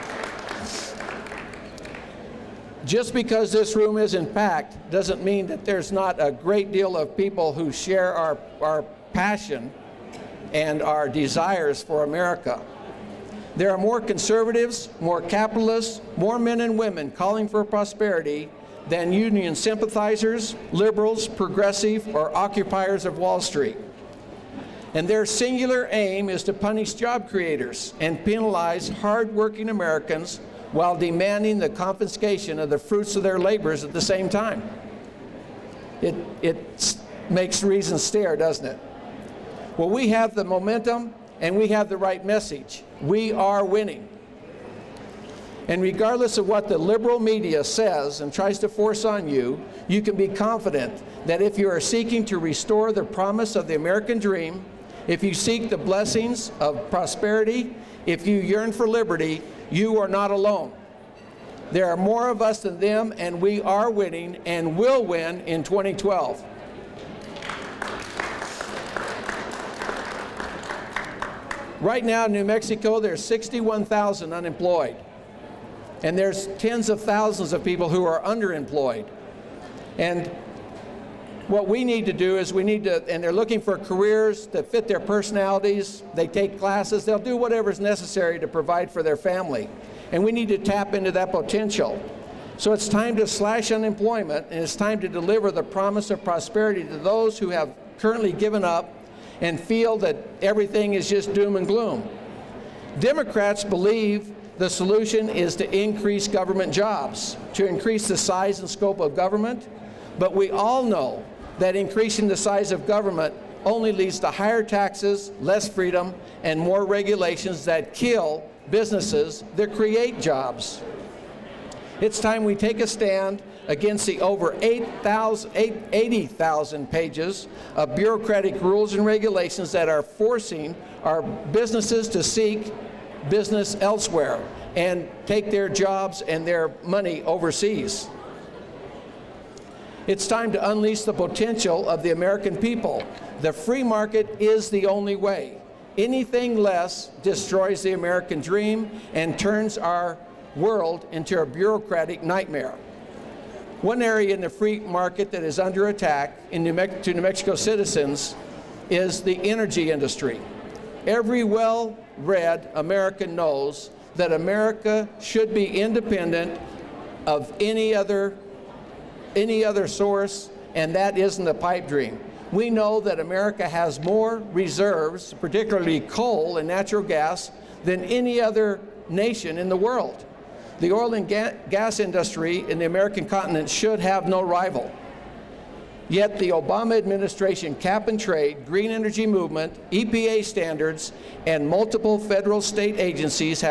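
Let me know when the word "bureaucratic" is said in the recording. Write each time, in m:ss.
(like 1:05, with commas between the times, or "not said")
2:07, 2:31.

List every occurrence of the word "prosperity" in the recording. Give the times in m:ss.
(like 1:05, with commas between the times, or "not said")
0:17, 0:56, 1:36.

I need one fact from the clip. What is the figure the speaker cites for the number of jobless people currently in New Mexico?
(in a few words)
61,000.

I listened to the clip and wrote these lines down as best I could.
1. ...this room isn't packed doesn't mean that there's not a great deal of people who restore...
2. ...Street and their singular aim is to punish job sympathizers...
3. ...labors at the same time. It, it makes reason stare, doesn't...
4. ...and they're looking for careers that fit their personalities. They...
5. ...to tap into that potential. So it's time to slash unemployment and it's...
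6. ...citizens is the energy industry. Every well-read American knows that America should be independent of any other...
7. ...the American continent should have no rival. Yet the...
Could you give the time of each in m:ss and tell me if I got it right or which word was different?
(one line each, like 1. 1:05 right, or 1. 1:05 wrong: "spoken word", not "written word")
1. 0:03 wrong: "share", not "restore"
2. 0:23 wrong: "creators", not "sympathizers"
3. 0:33 right
4. 1:23 right
5. 1:30 right
6. 2:37 right
7. 3:02 right.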